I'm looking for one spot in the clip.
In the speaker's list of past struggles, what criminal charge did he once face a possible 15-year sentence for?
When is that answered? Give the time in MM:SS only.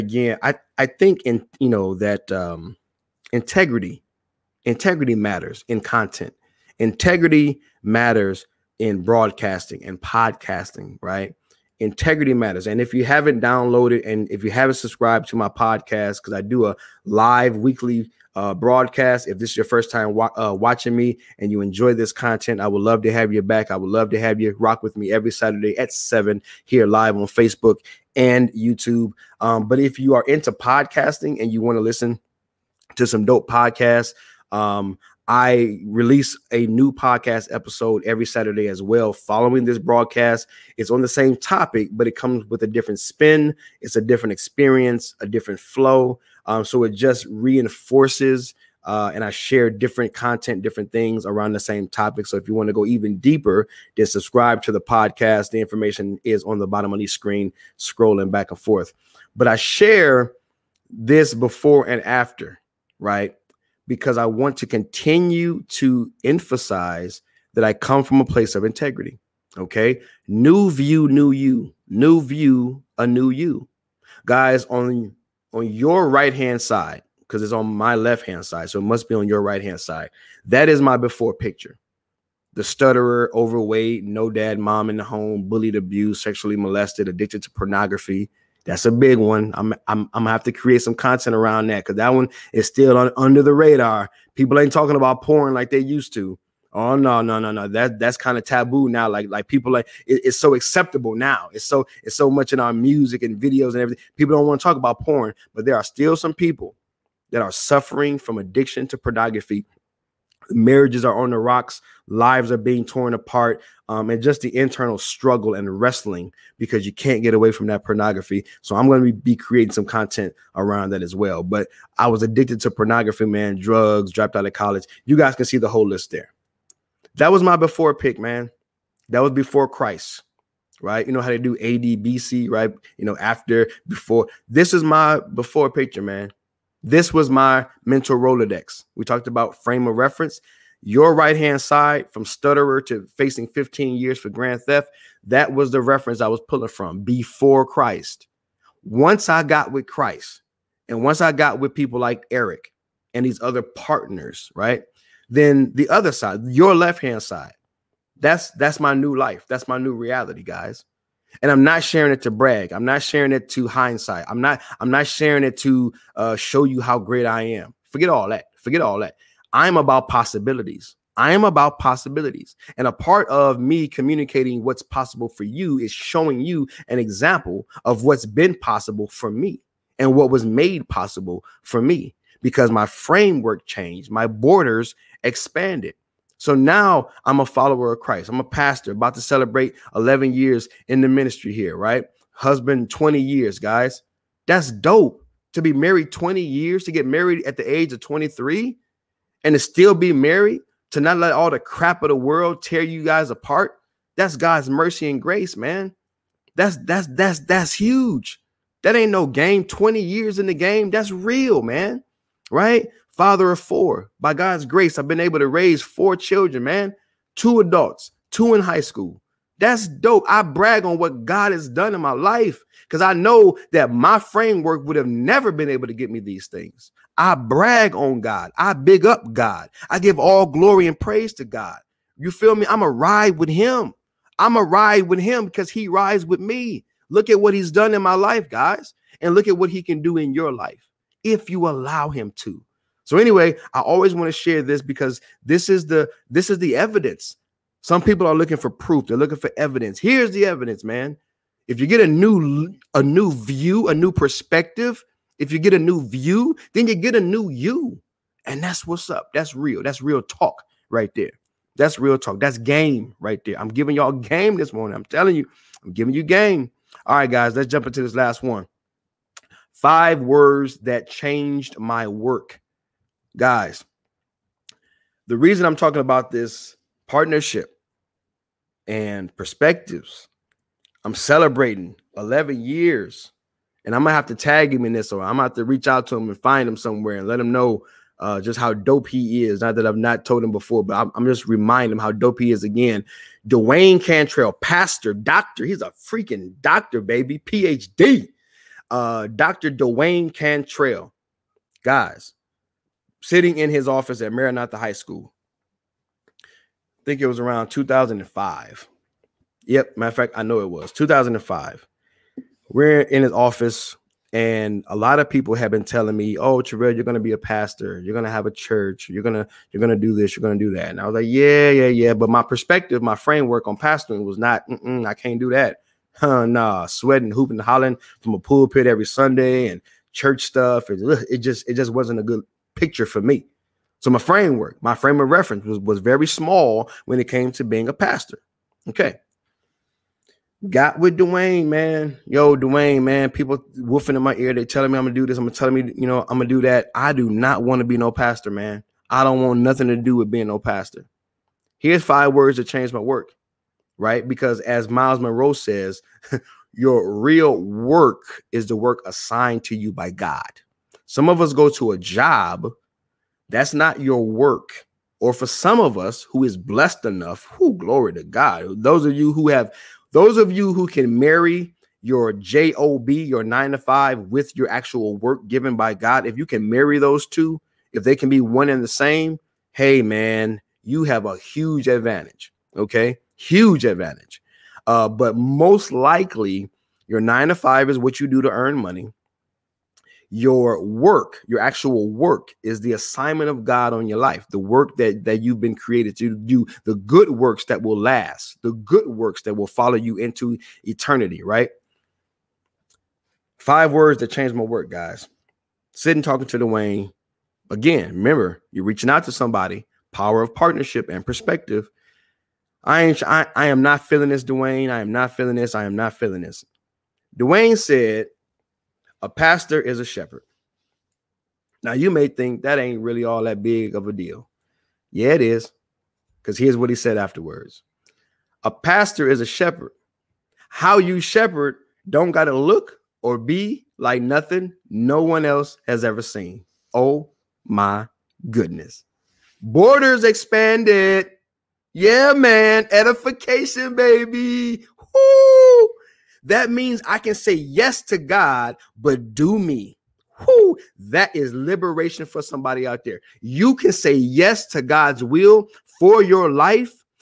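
02:24.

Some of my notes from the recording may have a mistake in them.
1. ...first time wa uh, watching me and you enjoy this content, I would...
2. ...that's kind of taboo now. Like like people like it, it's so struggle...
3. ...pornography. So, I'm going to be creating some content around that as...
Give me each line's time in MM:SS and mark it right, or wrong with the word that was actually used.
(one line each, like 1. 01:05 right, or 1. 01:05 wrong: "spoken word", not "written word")
1. 00:19 right
2. 01:37 wrong: "acceptable", not "struggle"
3. 01:57 right.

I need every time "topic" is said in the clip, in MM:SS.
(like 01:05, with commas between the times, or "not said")
00:41, 00:51.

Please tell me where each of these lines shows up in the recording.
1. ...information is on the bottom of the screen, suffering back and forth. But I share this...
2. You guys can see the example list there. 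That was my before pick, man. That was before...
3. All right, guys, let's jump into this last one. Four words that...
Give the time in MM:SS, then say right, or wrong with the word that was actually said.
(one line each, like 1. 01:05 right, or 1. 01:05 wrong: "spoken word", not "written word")
1. 00:55 wrong: "scrolling", not "suffering"
2. 02:05 wrong: "whole", not "example"
3. 04:27 wrong: "Five", not "Four".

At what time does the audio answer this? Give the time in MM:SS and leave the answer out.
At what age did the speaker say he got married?
03:18.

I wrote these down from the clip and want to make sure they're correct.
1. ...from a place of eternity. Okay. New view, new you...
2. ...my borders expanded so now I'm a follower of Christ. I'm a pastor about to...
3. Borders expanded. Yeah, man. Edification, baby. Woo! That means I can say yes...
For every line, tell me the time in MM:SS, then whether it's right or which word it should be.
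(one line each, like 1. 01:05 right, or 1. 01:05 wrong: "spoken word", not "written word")
1. 01:08 wrong: "integrity", not "eternity"
2. 03:04 right
3. 07:19 right.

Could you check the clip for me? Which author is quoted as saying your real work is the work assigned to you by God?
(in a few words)
Myles Munroe.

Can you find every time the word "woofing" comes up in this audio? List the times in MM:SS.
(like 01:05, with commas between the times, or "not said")
05:43.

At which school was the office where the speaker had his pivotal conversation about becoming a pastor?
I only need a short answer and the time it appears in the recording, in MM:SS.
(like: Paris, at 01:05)
Maranatha High School, at 05:04.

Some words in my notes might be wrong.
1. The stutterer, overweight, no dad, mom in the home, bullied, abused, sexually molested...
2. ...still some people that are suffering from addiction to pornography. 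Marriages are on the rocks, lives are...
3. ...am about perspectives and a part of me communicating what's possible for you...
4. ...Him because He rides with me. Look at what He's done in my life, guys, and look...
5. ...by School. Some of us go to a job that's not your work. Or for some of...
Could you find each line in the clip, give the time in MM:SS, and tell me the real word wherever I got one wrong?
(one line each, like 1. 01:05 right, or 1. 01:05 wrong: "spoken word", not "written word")
1. 01:22 right
2. 01:45 right
3. 02:51 wrong: "possibilities", not "perspectives"
4. 03:55 right
5. 05:59 wrong: "God", not "School".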